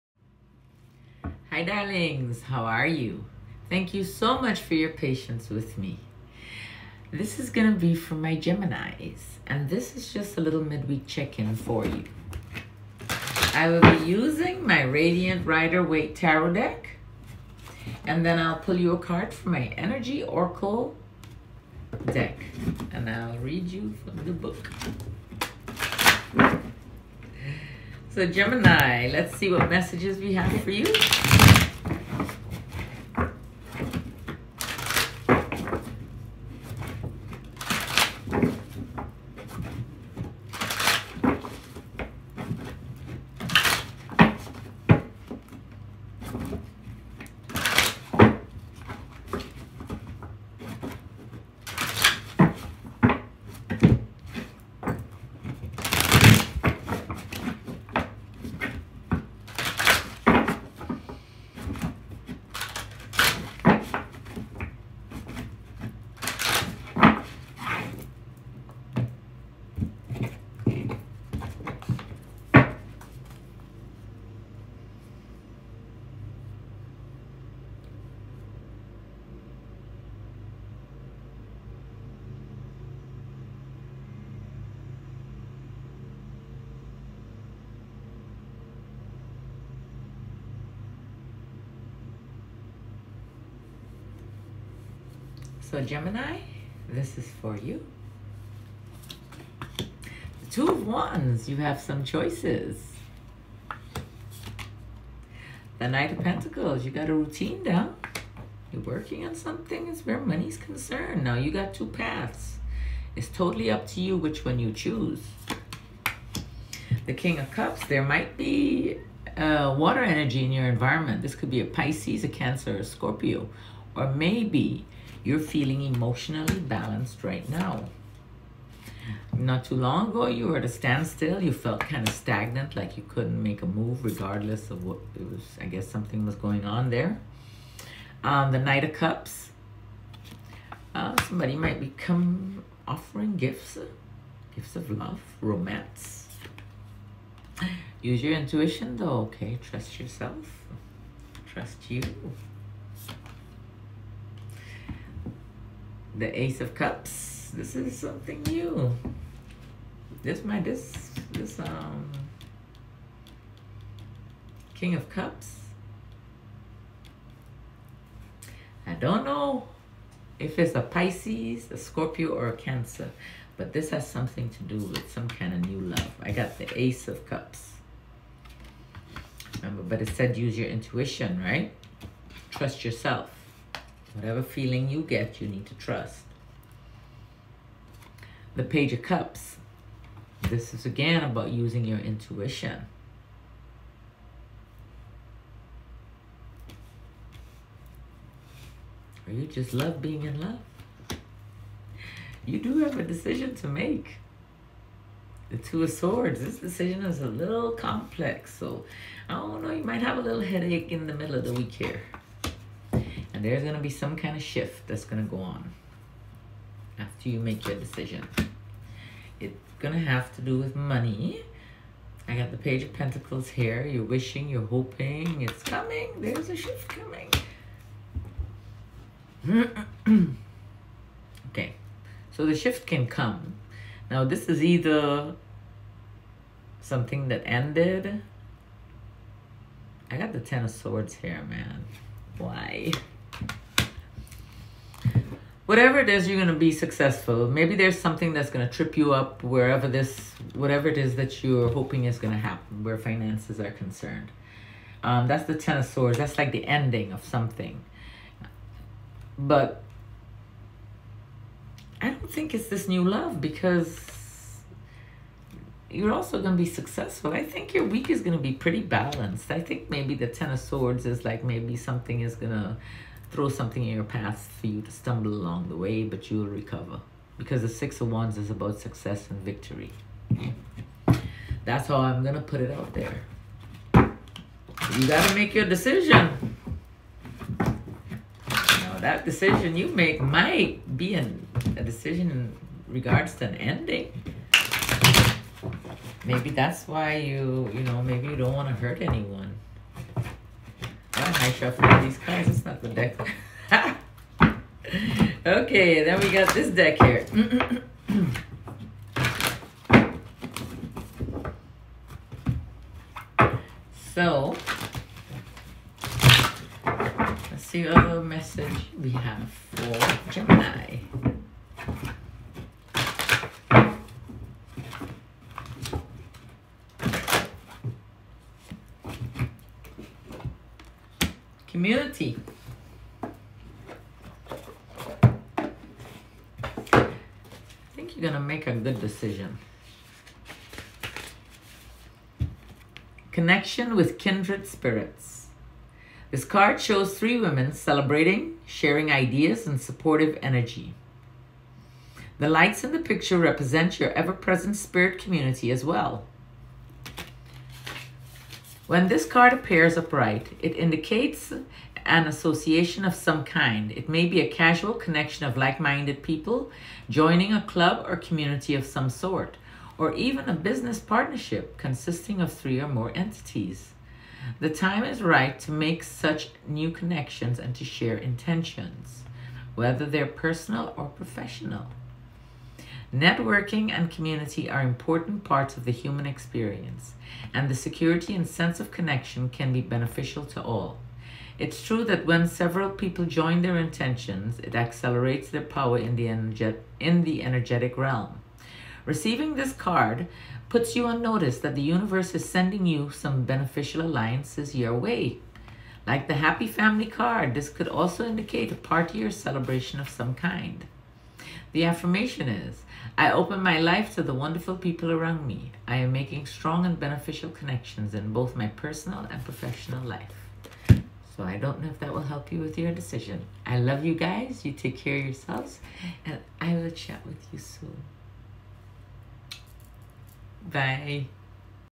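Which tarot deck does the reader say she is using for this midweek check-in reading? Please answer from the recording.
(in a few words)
Radiant Rider Waite.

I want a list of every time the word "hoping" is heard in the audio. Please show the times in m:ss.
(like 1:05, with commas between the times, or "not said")
3:44, 4:11.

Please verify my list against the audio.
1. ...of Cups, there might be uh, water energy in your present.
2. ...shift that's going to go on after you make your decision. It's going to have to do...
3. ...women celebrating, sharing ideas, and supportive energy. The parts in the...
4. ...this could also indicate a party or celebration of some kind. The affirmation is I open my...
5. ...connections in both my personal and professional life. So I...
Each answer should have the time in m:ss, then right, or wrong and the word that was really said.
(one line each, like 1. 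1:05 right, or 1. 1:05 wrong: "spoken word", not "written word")
1. 1:57 wrong: "environment", not "present"
2. 3:34 right
3. 5:47 wrong: "lights", not "parts"
4. 6:47 right
5. 6:57 right.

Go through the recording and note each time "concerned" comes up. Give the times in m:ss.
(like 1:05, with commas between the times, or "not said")
1:50, 4:13.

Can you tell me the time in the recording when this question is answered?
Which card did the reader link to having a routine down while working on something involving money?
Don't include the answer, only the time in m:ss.
1:45.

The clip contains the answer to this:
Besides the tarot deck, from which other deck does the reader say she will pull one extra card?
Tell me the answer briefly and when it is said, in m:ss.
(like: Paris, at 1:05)
Energy Oracle, at 0:19.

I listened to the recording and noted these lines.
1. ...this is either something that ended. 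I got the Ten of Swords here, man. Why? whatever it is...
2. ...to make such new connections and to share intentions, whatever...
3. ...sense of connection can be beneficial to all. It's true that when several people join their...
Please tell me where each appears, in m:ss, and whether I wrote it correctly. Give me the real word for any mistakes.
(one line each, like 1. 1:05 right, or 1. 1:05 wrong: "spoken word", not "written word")
1. 3:54 right
2. 6:15 wrong: "whether", not "whatever"
3. 6:28 right.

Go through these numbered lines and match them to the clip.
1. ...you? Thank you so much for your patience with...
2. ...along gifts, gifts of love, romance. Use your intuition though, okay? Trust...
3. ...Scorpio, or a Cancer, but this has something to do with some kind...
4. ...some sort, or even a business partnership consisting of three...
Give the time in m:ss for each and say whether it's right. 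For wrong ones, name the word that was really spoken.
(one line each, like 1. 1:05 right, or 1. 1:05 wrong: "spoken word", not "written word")
1. 0:02 right
2. 2:22 wrong: "offering", not "along"
3. 2:51 right
4. 6:08 right.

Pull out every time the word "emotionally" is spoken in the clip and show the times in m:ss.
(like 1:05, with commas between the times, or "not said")
2:05.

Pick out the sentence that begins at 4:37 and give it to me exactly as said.
Because the Six of Wands is about success and victory.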